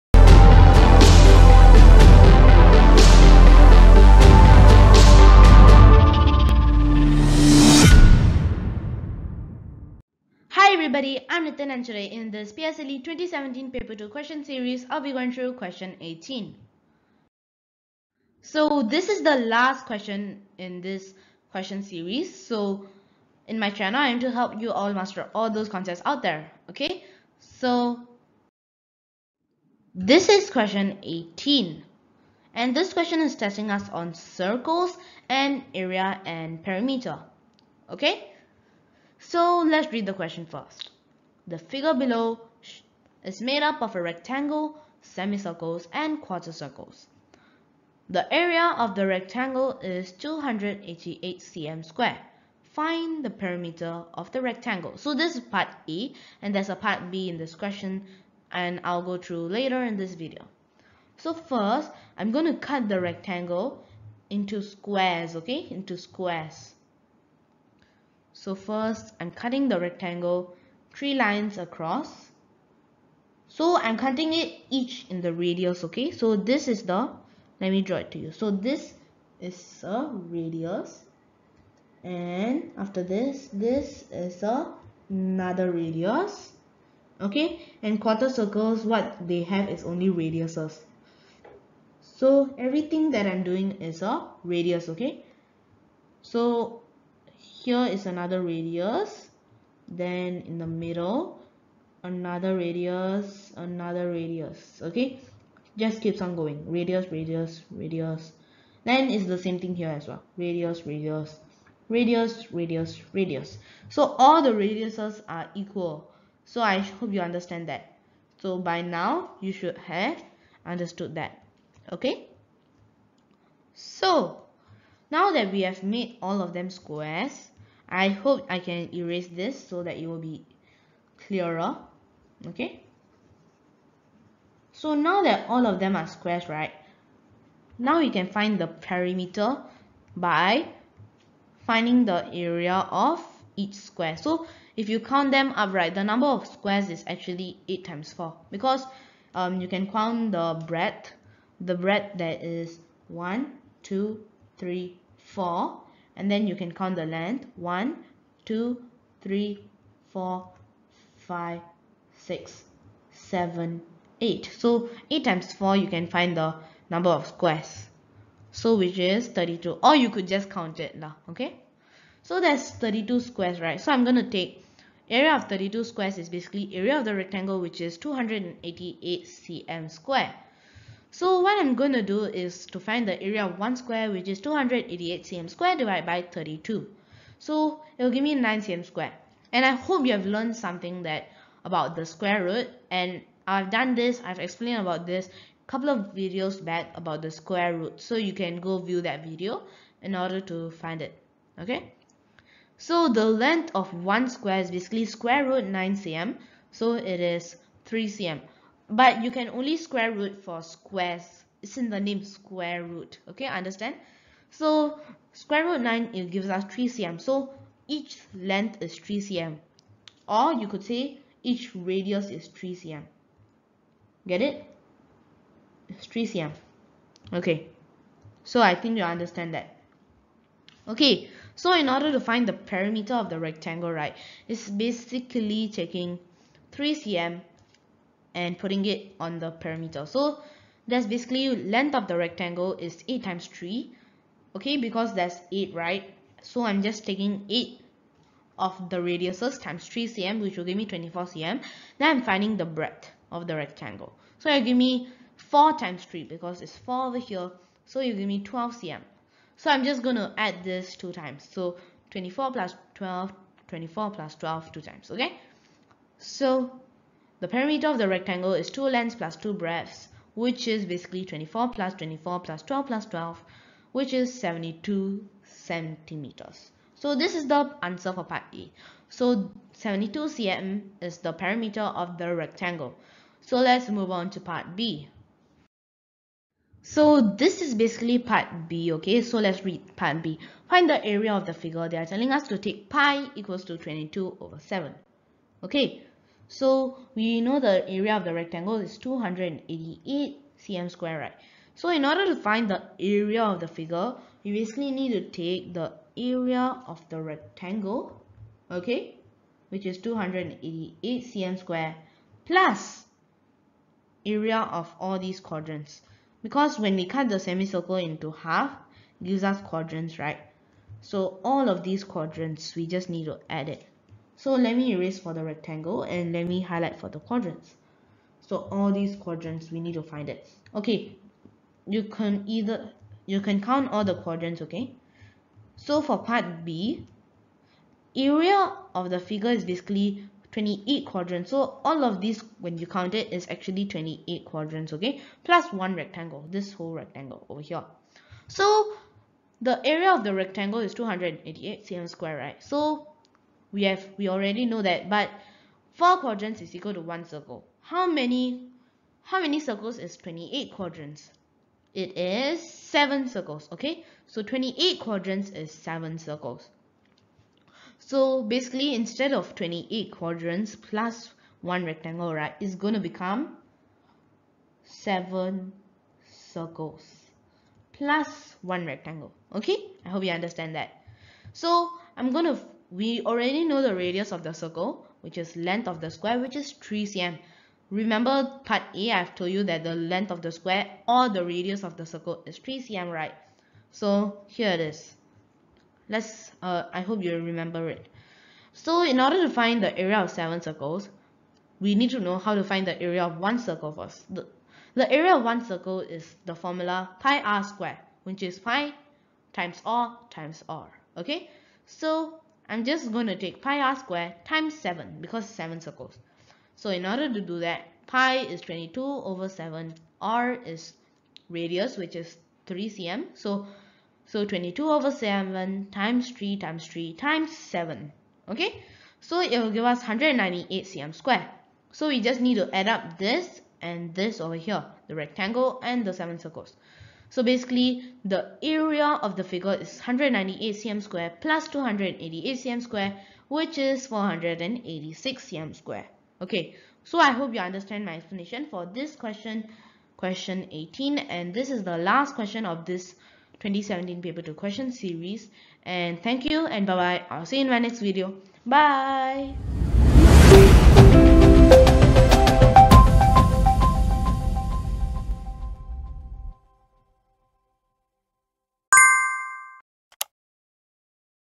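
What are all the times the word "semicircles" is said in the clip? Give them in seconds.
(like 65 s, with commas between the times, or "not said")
45 s, 317 s.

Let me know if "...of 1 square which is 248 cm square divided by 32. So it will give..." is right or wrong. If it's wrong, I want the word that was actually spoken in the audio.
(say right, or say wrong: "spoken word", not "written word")
wrong: "288", not "248".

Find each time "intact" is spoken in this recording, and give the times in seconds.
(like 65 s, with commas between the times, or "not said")
not said.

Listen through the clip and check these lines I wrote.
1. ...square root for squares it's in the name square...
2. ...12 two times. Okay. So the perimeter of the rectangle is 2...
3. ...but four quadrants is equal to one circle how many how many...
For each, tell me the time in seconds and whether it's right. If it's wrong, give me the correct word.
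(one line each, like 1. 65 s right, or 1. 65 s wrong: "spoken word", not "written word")
1. 209 s right
2. 264 s right
3. 355 s right.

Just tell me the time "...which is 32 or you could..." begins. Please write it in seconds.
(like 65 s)
168 s.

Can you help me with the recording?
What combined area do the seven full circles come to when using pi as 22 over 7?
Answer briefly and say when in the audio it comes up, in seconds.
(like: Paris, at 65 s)
198 cm², at 429 s.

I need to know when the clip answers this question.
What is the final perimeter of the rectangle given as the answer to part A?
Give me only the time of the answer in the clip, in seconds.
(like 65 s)
274 s.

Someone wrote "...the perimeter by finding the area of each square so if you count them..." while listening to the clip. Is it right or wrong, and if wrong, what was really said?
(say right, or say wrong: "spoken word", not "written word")
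right.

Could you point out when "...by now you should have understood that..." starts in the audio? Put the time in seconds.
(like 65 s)
118 s.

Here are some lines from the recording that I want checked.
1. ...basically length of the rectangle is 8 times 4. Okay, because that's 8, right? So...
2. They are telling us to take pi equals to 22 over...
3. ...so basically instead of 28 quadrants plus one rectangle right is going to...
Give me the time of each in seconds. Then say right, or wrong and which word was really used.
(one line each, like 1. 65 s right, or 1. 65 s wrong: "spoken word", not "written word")
1. 241 s wrong: "3", not "4"
2. 291 s right
3. 367 s right.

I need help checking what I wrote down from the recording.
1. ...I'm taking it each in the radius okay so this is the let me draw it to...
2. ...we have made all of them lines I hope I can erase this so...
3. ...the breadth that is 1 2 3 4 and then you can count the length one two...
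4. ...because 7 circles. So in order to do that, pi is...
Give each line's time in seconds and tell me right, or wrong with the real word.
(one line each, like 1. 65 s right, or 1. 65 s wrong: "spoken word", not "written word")
1. 73 s wrong: "cutting", not "taking"
2. 125 s wrong: "squares", not "lines"
3. 151 s right
4. 415 s right.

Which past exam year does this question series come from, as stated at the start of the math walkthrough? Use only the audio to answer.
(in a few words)
2017.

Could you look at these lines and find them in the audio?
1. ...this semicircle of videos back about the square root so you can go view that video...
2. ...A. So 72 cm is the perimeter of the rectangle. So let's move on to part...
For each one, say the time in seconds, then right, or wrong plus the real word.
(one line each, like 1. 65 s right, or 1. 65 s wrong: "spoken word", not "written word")
1. 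195 s wrong: "couple", not "semicircle"
2. 278 s right.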